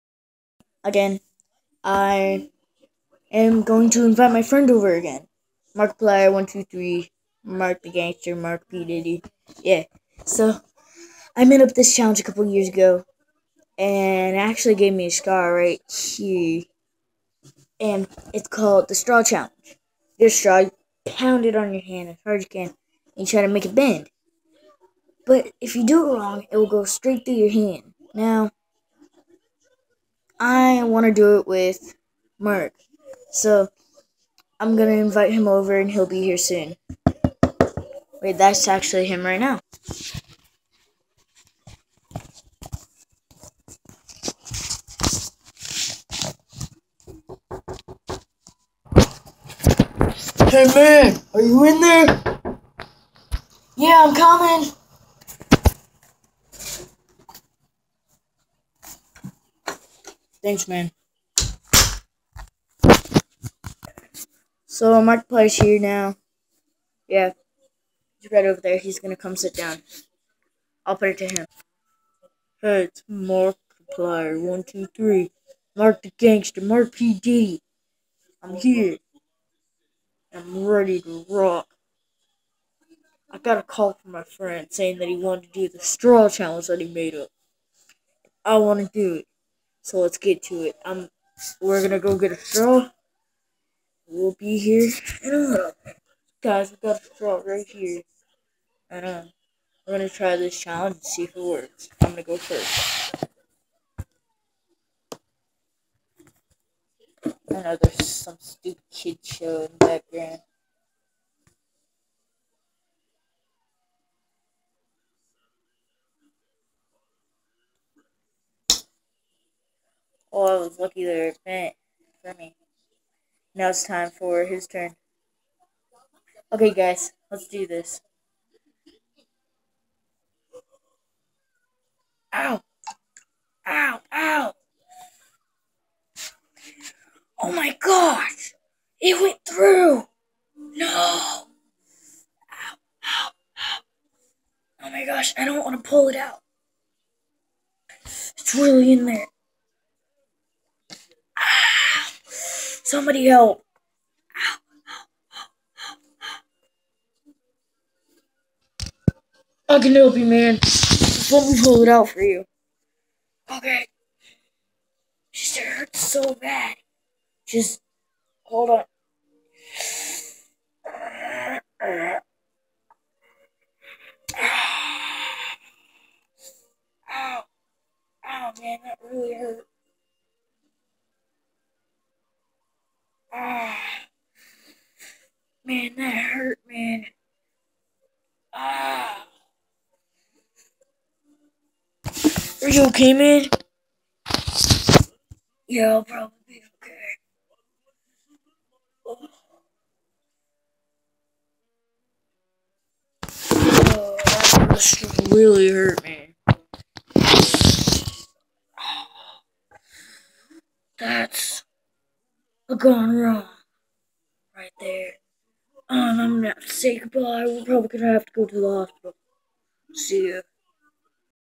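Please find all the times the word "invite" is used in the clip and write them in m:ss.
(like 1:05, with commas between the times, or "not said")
0:04, 0:34.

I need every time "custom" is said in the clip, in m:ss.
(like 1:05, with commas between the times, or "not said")
not said.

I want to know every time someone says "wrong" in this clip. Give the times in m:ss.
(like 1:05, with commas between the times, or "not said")
0:26, 3:33.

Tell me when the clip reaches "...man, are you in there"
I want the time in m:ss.
0:50.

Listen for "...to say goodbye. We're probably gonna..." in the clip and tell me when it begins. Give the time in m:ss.
3:36.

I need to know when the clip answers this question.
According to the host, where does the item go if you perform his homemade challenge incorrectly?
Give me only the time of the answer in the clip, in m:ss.
0:26.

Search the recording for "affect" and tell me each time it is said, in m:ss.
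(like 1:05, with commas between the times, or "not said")
not said.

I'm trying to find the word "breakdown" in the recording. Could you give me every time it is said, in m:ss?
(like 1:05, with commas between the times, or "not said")
not said.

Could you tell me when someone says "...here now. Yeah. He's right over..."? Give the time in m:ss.
1:05.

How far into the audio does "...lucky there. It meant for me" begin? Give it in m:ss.
2:00.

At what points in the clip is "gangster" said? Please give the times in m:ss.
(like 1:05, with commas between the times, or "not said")
0:07, 1:16.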